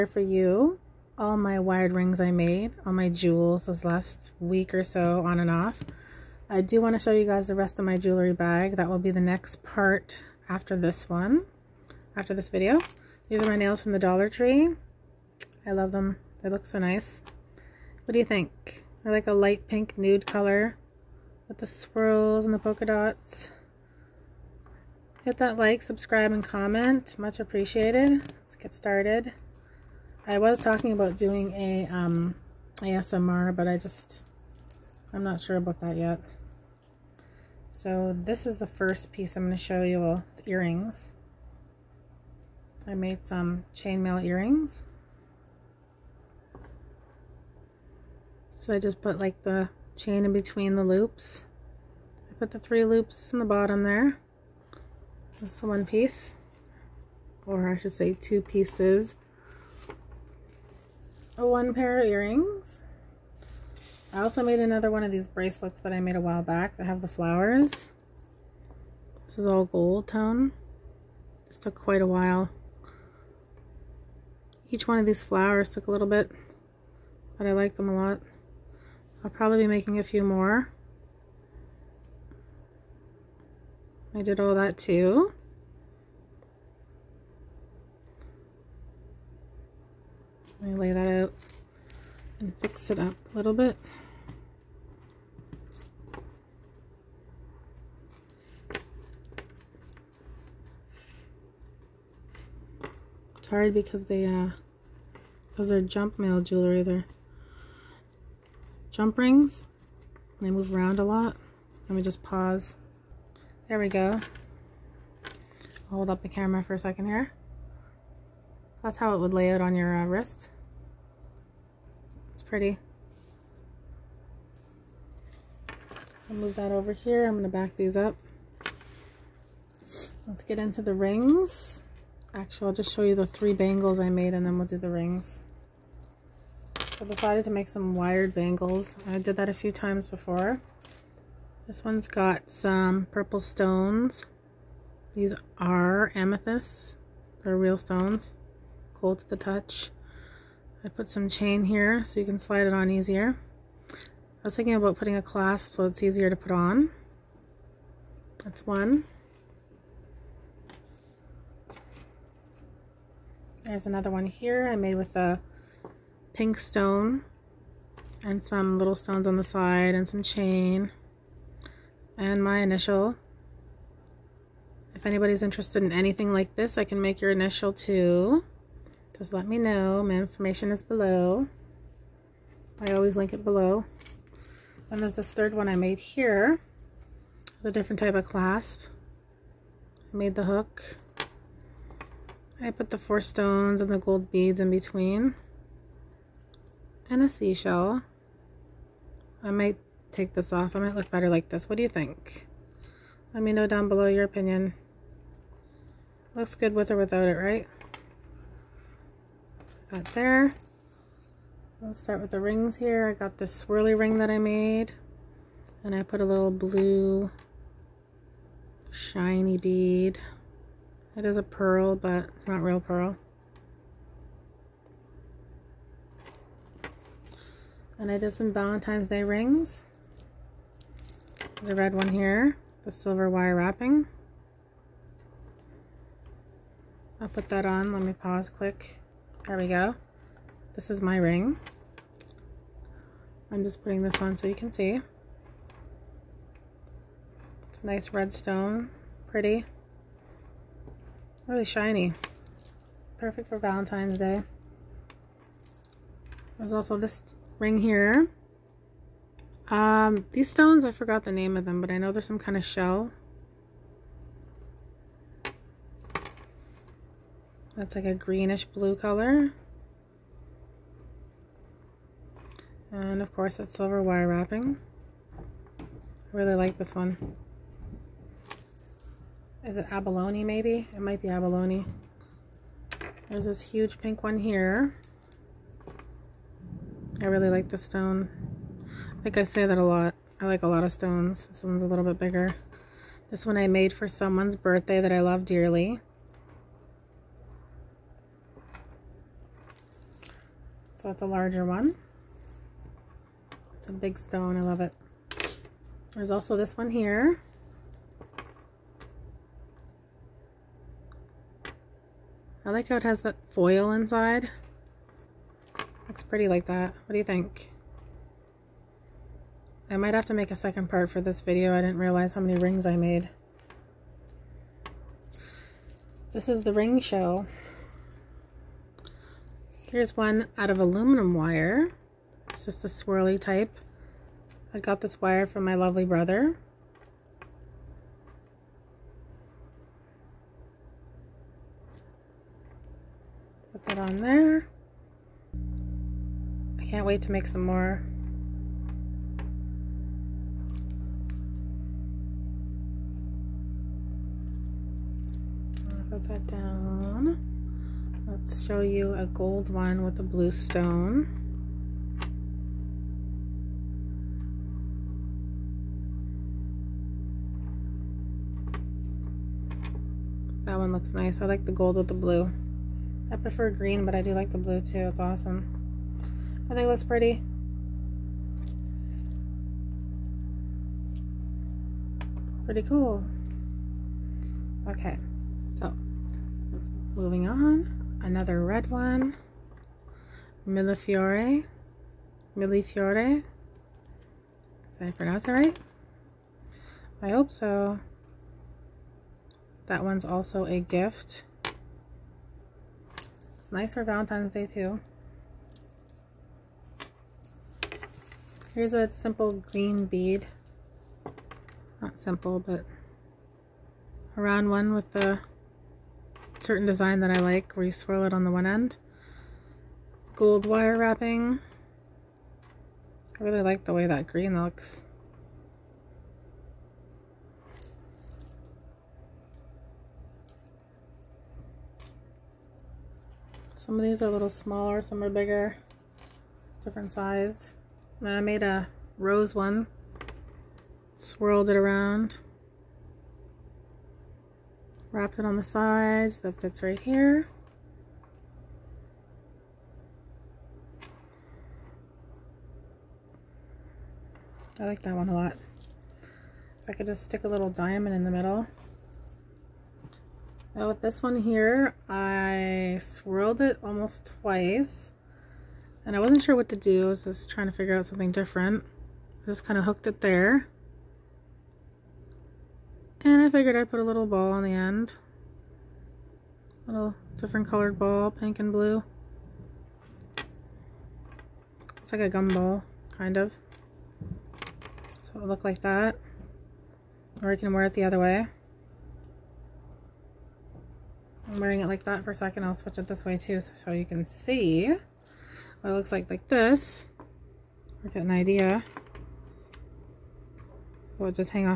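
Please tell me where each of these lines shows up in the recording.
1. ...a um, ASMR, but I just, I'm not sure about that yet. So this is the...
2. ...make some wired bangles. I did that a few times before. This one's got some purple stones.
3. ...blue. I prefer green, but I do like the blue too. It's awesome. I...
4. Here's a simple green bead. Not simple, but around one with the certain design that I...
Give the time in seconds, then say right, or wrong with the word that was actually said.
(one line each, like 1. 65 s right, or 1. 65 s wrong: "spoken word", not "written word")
1. 31 s right
2. 137 s right
3. 372 s right
4. 408 s right.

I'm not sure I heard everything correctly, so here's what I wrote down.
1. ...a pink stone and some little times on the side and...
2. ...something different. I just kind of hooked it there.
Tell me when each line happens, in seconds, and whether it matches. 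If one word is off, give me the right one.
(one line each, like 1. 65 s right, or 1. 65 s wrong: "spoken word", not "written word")
1. 165 s wrong: "stones", not "times"
2. 468 s right.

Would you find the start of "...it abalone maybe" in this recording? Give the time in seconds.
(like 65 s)
279 s.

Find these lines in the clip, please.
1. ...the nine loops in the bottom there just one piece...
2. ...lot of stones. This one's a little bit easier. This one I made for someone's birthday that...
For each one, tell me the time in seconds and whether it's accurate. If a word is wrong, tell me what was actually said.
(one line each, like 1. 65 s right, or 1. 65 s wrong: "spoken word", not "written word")
1. 52 s wrong: "three", not "nine"
2. 290 s wrong: "bigger", not "easier".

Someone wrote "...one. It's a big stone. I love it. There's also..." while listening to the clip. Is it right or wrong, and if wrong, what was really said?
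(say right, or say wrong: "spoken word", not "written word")
right.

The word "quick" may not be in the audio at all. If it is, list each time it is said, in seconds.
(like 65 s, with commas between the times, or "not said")
238 s.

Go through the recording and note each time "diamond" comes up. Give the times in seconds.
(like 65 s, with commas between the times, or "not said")
457 s.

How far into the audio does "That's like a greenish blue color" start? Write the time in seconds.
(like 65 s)
267 s.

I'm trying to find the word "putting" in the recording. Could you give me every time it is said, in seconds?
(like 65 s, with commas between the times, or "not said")
154 s, 243 s.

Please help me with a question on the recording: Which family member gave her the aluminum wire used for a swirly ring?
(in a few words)
brother.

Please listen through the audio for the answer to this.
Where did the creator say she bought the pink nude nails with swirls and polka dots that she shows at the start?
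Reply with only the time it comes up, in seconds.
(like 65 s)
13 s.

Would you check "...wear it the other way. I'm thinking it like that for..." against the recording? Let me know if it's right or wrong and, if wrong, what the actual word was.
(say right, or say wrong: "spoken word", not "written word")
wrong: "wearing", not "thinking".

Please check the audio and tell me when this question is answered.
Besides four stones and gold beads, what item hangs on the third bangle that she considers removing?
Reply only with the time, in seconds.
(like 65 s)
197 s.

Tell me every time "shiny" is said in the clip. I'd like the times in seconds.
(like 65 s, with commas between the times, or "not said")
218 s, 251 s.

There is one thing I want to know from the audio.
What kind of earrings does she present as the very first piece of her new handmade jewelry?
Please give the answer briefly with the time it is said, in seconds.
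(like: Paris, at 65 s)
chainmail earrings, at 43 s.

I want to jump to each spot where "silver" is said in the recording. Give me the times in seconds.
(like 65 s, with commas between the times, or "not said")
232 s, 273 s.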